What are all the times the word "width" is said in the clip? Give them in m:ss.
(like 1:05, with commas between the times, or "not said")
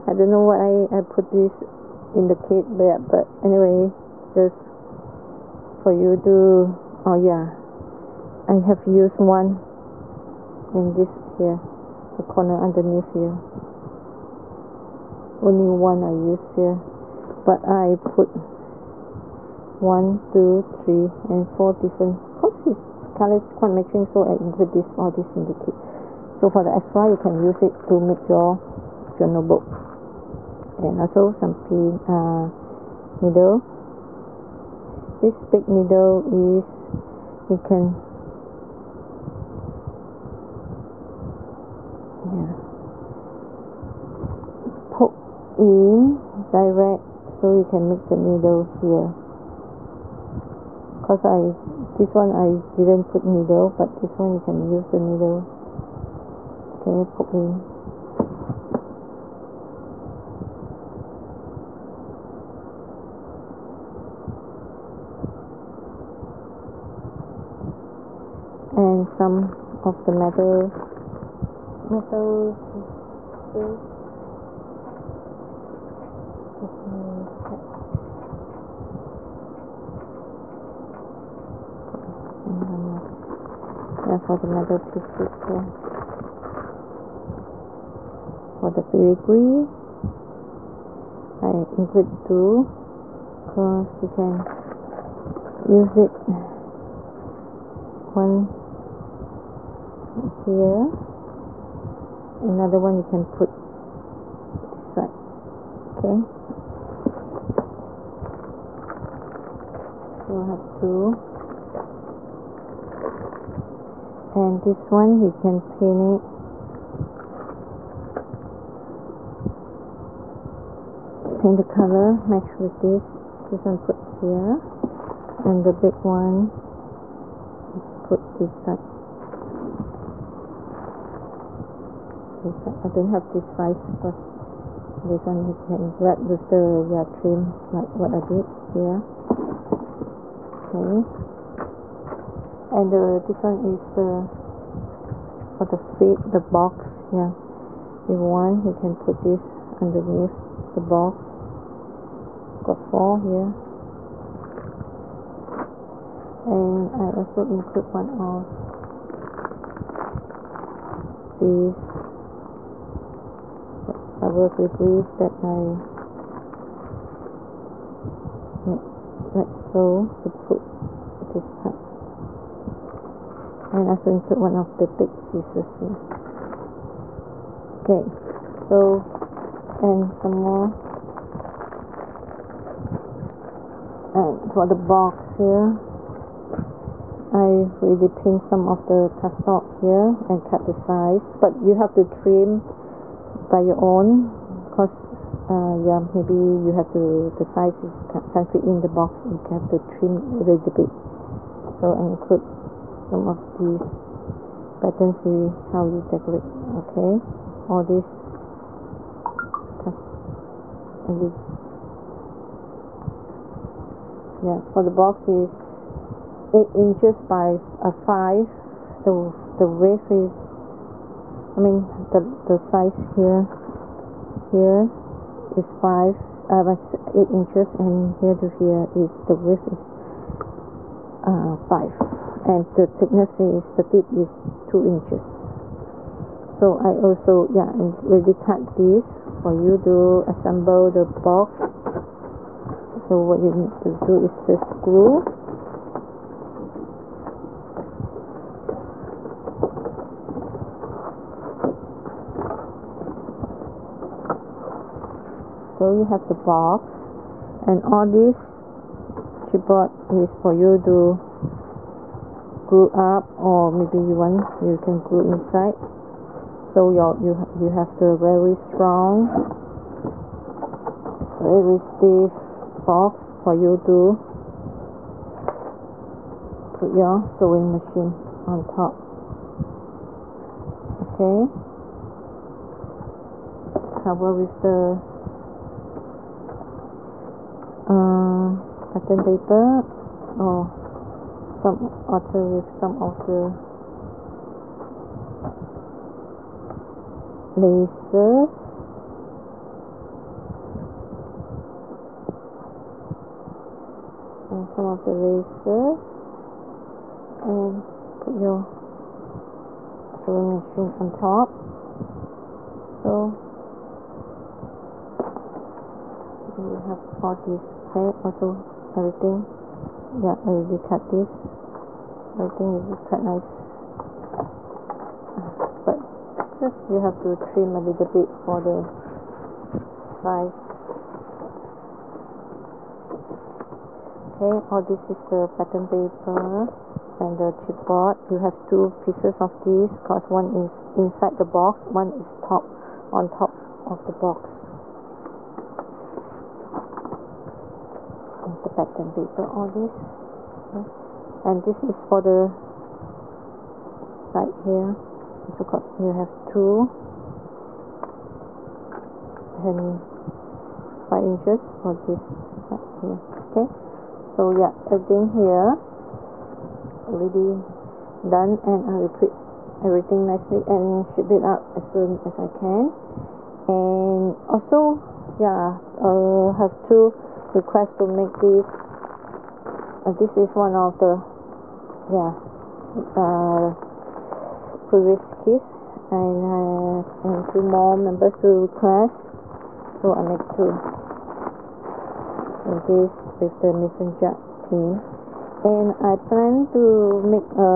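3:39, 3:49.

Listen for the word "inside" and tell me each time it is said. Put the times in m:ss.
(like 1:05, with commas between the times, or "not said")
4:25, 5:40.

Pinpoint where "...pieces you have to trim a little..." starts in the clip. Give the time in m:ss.
5:26.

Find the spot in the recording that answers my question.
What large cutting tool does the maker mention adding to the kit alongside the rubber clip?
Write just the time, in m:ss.
2:54.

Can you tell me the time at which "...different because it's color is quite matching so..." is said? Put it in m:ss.
0:21.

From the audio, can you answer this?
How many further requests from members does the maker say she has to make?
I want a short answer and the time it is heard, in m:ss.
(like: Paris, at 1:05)
2, at 6:16.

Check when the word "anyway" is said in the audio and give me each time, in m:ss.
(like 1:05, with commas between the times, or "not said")
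0:03.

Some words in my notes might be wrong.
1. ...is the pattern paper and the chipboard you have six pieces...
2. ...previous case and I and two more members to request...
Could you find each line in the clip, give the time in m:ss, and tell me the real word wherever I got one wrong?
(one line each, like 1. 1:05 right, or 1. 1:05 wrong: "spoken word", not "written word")
1. 5:35 wrong: "two", not "six"
2. 6:24 right.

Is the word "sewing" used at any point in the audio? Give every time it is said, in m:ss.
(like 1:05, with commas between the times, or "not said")
4:37, 5:10.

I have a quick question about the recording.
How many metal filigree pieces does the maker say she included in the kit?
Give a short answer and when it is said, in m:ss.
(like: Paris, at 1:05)
2, at 1:31.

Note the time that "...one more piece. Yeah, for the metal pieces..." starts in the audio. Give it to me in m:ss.
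1:22.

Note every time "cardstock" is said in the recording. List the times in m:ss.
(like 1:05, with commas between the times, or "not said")
3:09.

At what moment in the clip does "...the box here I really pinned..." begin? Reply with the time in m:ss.
3:04.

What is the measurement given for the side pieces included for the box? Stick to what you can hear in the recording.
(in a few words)
5 inches.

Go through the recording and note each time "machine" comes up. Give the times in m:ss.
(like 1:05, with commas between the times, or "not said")
4:37, 5:10.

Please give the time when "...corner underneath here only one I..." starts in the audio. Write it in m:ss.
0:12.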